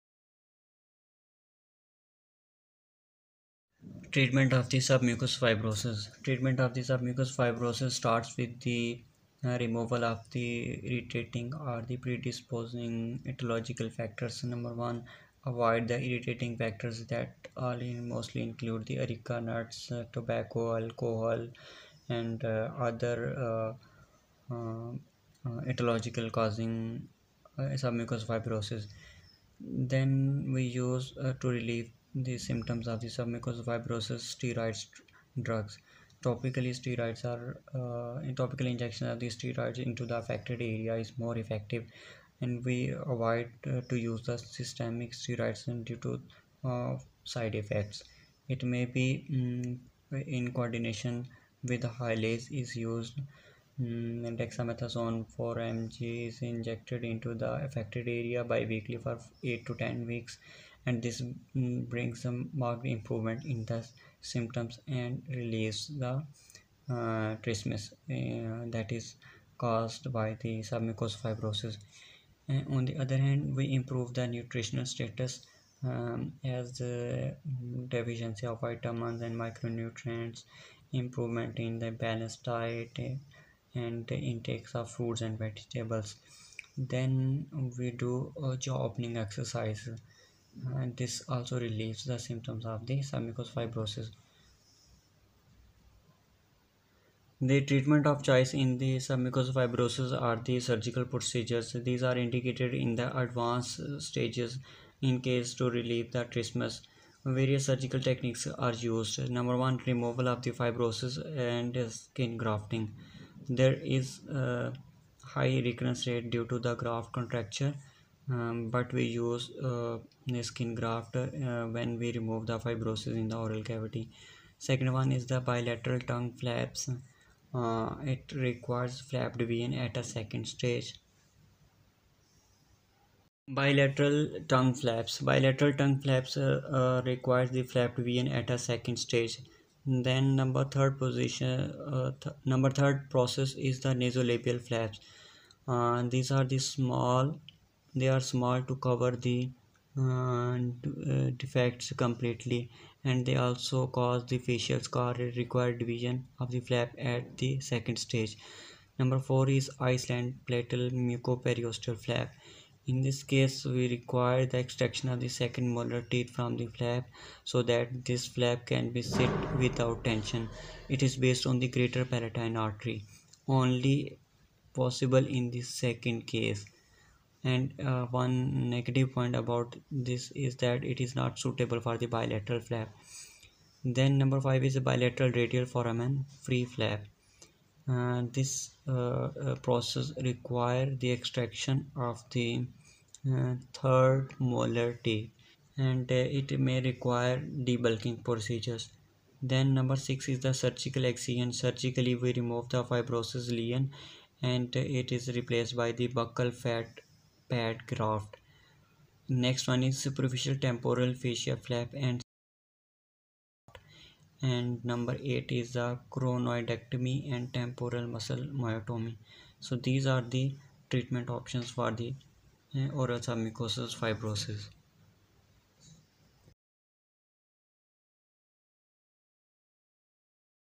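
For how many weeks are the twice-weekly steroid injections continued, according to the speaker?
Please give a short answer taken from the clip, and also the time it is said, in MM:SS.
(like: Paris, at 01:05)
8 to 10 weeks, at 00:59.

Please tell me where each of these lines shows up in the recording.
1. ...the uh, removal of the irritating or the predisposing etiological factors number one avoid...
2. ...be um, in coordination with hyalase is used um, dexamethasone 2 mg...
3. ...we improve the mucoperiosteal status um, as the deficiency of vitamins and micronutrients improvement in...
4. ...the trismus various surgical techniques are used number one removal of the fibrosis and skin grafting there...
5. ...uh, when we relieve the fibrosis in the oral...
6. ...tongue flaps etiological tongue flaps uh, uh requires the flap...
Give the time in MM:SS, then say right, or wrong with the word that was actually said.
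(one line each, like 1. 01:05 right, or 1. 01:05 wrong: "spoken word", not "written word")
1. 00:08 right
2. 00:48 wrong: "4", not "2"
3. 01:13 wrong: "nutritional", not "mucoperiosteal"
4. 01:46 right
5. 02:01 wrong: "remove", not "relieve"
6. 02:14 wrong: "bilateral", not "etiological".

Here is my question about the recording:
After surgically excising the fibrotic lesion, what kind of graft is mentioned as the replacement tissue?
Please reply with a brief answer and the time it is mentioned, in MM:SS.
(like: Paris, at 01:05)
Buccal fat pad graft, at 03:26.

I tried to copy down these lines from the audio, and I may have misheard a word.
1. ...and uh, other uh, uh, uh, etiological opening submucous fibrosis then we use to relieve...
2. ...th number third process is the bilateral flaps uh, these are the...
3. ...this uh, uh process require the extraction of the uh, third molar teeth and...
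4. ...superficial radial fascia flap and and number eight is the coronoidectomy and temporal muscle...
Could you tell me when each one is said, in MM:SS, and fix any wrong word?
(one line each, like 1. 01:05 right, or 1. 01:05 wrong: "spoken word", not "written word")
1. 00:22 wrong: "causing", not "opening"
2. 02:22 wrong: "nasolabial", not "bilateral"
3. 03:08 right
4. 03:30 wrong: "temporal", not "radial".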